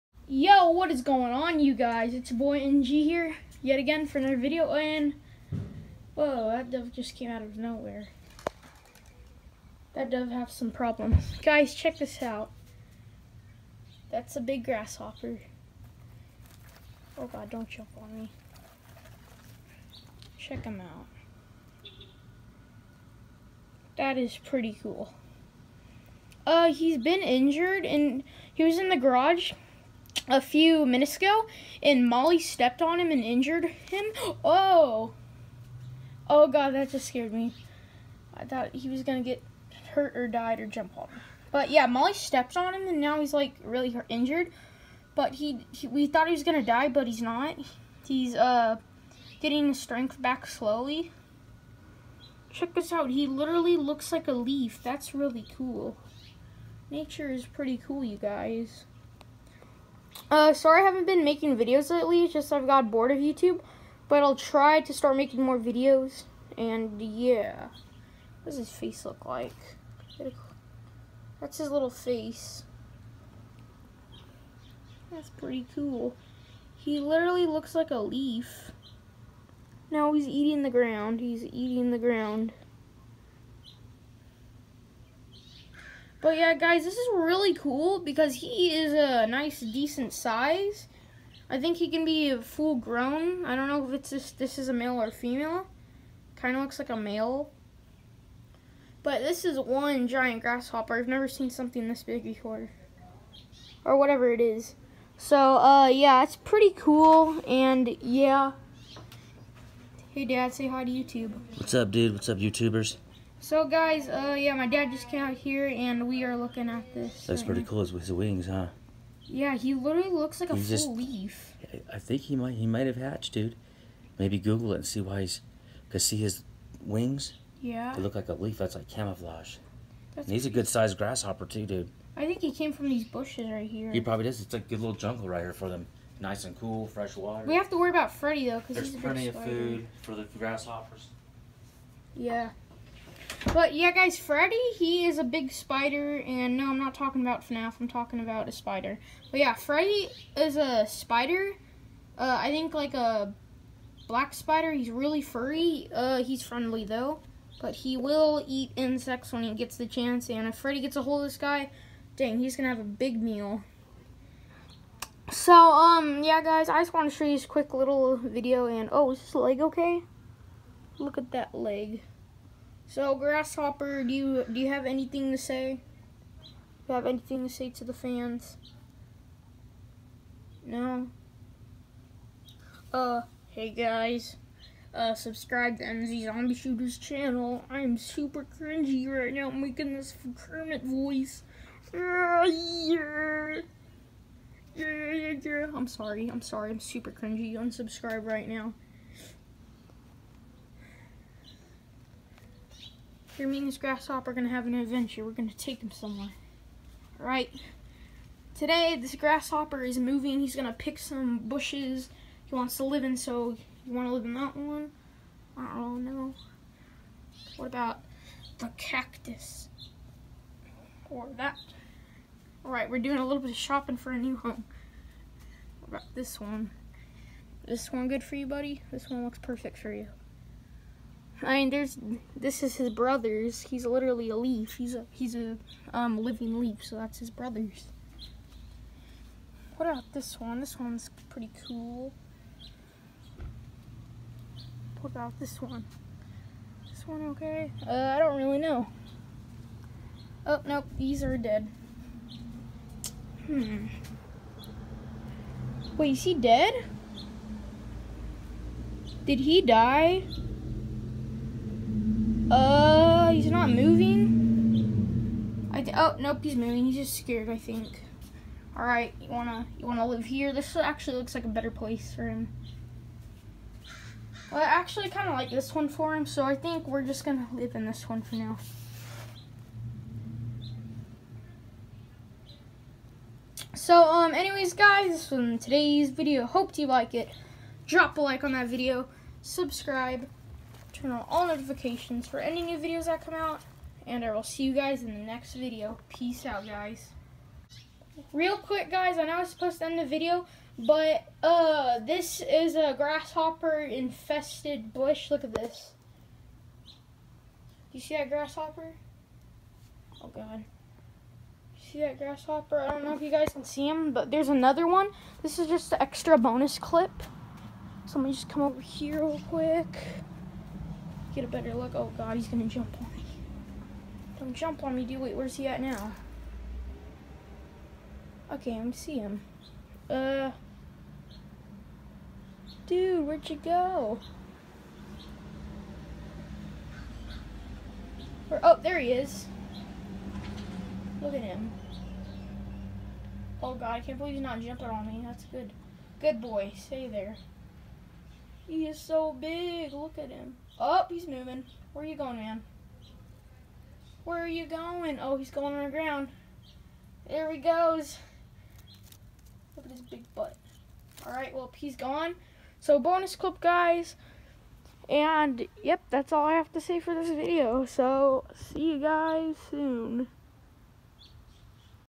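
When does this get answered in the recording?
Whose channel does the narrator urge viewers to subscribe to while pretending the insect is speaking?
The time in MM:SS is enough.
03:05.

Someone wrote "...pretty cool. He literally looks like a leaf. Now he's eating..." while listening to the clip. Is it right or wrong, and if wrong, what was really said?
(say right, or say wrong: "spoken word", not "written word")
right.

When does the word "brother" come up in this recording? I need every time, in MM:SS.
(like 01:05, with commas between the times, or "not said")
03:52, 03:57.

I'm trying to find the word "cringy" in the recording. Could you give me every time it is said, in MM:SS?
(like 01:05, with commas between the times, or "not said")
03:08, 03:17.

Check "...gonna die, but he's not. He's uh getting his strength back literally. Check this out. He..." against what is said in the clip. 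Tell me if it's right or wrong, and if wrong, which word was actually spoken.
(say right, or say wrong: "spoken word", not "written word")
wrong: "slowly", not "literally".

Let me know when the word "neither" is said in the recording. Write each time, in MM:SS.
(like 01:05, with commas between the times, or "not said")
not said.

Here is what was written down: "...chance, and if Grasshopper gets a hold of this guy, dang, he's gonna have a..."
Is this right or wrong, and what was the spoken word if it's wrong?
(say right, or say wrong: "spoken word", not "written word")
wrong: "Freddy", not "Grasshopper".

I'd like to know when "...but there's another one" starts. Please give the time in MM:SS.
05:14.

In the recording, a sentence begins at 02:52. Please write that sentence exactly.
So, Grasshopper, do you do you have anything to say?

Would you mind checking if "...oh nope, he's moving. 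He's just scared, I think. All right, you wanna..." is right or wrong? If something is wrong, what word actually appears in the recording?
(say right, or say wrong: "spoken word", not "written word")
right.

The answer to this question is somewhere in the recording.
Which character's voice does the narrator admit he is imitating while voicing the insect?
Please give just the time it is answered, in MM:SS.
03:10.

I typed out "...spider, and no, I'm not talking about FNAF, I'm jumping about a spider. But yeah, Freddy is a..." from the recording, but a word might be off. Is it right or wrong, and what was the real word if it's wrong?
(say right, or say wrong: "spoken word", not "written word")
wrong: "talking", not "jumping".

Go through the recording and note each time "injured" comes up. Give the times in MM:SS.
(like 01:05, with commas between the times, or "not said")
00:27, 00:33, 00:44.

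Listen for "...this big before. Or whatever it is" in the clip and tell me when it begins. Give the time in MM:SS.
01:41.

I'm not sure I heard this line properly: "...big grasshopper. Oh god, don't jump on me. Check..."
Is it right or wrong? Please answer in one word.
right.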